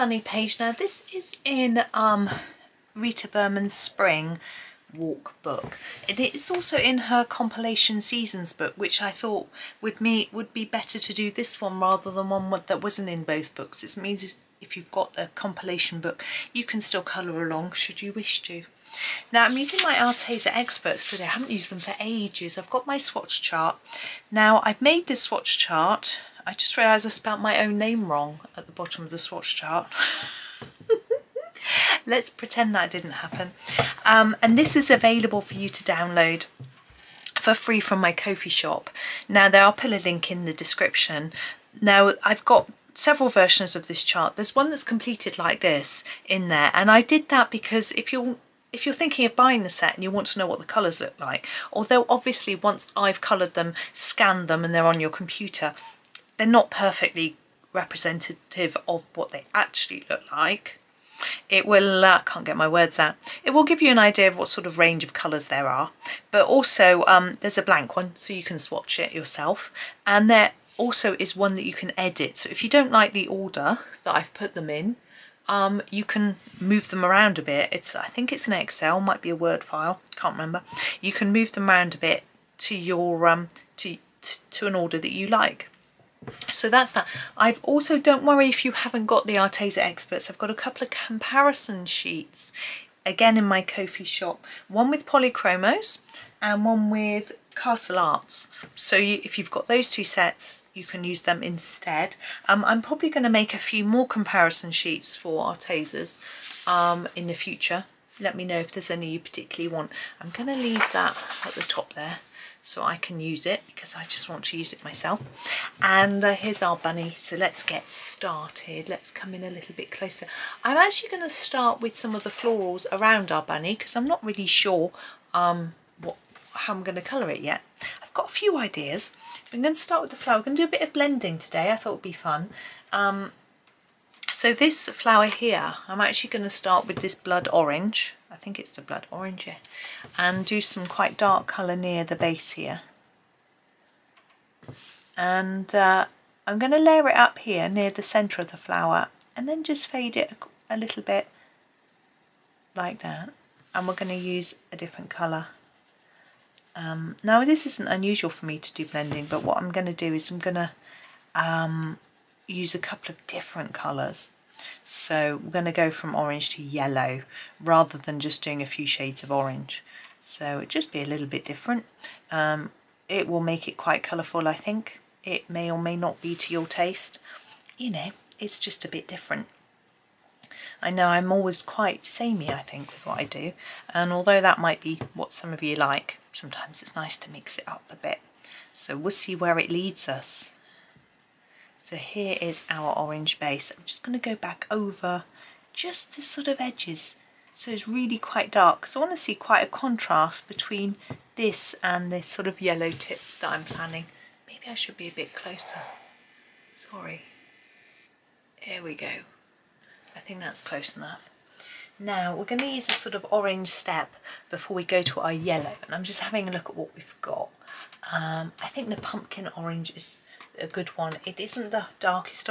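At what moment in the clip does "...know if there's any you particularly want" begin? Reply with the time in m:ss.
1:48.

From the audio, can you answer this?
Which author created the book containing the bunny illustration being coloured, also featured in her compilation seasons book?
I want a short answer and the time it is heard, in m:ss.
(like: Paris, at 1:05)
Rita Berman, at 0:02.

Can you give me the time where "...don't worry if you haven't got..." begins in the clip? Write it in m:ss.
1:27.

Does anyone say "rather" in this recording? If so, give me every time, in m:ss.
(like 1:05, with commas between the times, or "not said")
0:11, 2:47.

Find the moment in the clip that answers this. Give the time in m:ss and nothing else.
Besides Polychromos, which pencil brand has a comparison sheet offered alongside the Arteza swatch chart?
1:37.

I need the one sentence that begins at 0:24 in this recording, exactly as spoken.
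Now I've made this swatch chart, I just realised I spelt my own name wrong at the bottom of the swatch chart.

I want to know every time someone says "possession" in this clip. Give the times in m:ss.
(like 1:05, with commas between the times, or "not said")
not said.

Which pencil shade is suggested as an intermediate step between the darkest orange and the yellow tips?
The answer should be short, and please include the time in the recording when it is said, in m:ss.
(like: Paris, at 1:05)
Pumpkin orange, at 3:38.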